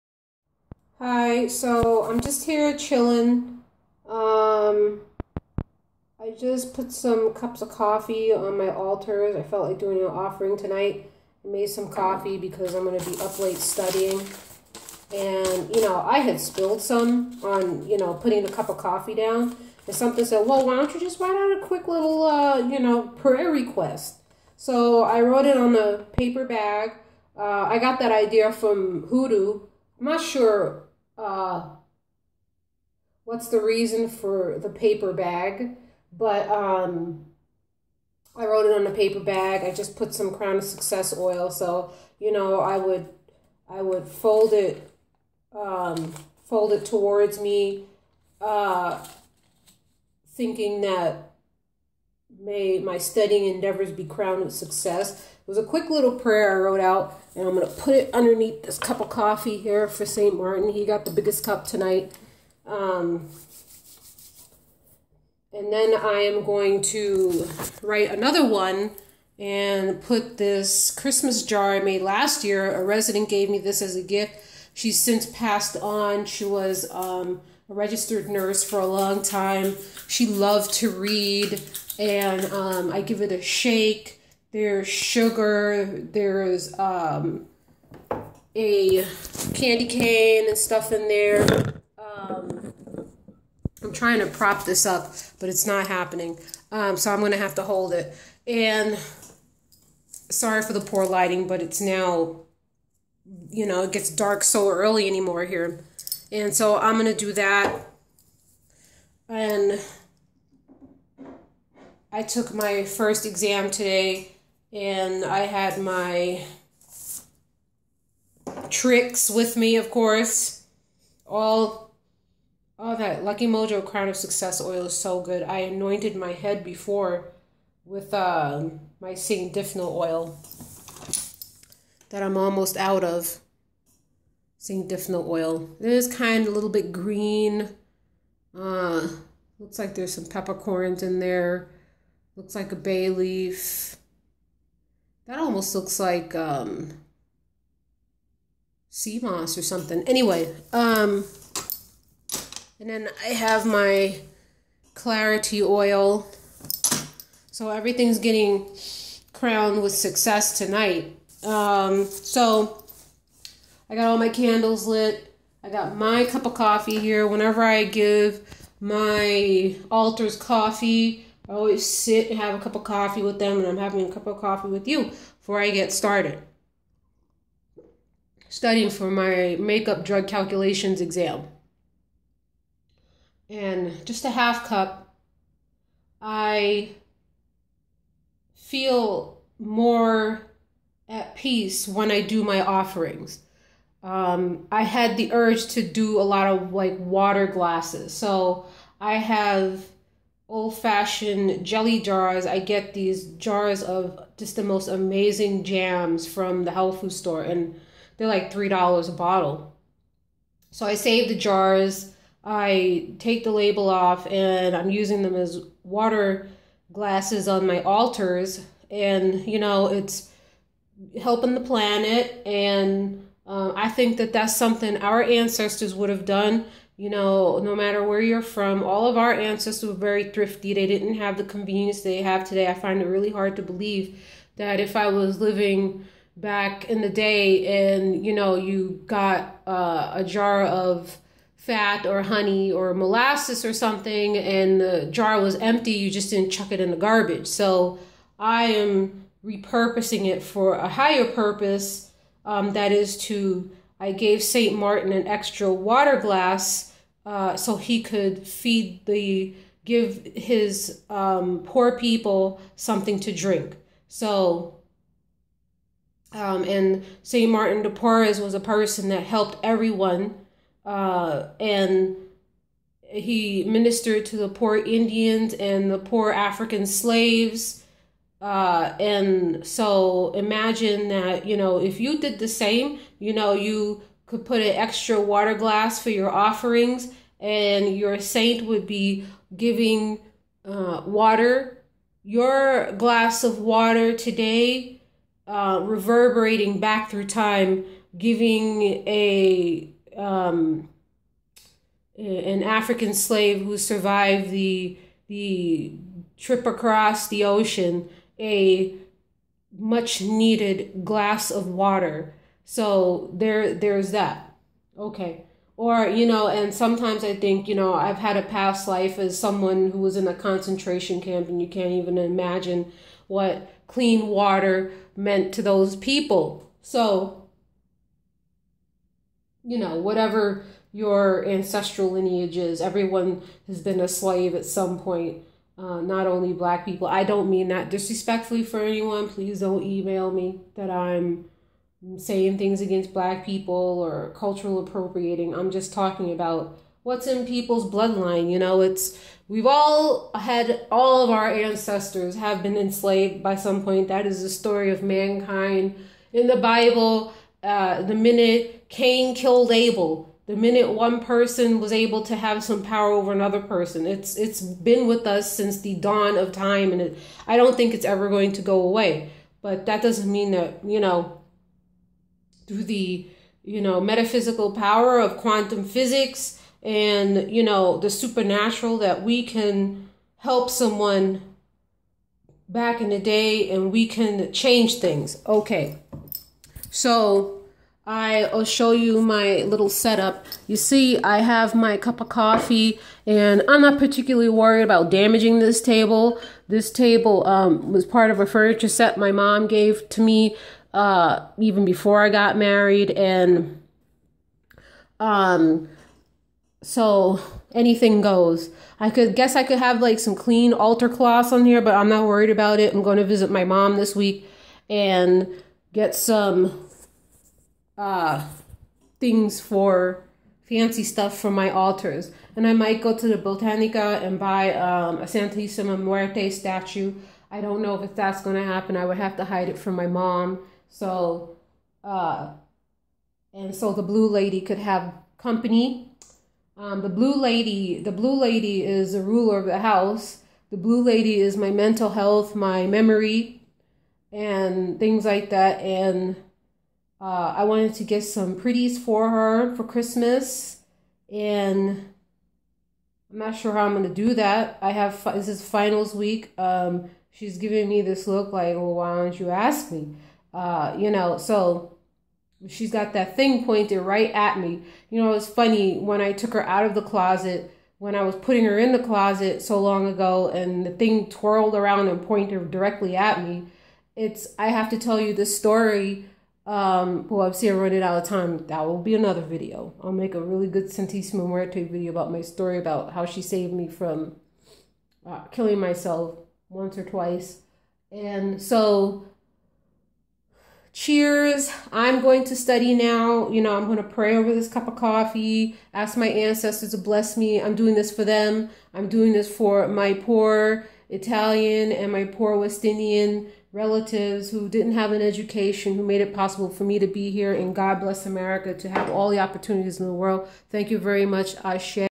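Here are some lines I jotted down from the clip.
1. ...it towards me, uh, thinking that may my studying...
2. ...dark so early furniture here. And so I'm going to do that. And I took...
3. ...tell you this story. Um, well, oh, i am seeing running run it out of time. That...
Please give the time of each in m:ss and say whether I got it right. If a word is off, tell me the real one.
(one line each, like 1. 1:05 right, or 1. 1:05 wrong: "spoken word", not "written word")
1. 0:46 right
2. 1:44 wrong: "anymore", not "furniture"
3. 7:54 right.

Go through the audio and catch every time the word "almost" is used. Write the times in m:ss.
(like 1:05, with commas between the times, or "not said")
2:12, 2:25.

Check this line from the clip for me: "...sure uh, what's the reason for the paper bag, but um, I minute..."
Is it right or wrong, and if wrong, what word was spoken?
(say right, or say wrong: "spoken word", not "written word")
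wrong: "wrote", not "minute".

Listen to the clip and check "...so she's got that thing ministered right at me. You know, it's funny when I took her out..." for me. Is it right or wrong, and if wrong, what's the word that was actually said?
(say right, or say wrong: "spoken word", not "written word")
wrong: "pointed", not "ministered".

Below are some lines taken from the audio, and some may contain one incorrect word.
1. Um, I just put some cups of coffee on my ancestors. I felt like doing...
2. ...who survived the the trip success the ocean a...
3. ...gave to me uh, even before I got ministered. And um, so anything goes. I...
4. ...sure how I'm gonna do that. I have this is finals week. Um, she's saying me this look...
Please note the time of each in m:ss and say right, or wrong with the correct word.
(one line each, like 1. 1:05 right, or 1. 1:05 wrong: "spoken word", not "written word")
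1. 0:04 wrong: "altars", not "ancestors"
2. 5:03 wrong: "across", not "success"
3. 6:39 wrong: "married", not "ministered"
4. 7:33 wrong: "giving", not "saying".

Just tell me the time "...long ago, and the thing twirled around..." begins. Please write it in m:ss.
7:49.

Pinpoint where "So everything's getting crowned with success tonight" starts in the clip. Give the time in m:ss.
2:37.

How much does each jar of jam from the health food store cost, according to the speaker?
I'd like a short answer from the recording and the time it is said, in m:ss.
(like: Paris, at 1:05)
$3, at 3:28.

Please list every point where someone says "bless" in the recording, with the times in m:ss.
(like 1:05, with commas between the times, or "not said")
8:16, 8:28.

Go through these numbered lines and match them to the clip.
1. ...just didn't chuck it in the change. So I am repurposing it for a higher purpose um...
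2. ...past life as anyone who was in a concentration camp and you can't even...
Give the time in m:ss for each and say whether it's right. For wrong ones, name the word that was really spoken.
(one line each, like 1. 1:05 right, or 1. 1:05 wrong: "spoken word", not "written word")
1. 4:06 wrong: "garbage", not "change"
2. 5:18 wrong: "someone", not "anyone".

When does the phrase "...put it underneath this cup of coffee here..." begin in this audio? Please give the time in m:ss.
0:57.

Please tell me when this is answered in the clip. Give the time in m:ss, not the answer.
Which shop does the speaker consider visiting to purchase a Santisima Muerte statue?
7:03.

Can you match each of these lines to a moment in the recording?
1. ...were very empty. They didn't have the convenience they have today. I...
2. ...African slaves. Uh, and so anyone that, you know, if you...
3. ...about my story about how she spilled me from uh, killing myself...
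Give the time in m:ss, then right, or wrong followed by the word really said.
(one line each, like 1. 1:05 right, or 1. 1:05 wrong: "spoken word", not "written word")
1. 3:49 wrong: "thrifty", not "empty"
2. 4:36 wrong: "imagine", not "anyone"
3. 8:02 wrong: "saved", not "spilled".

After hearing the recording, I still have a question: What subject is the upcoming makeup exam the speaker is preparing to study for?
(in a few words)
Drug calculations.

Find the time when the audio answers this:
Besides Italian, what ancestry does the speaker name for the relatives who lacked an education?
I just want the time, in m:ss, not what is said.
8:22.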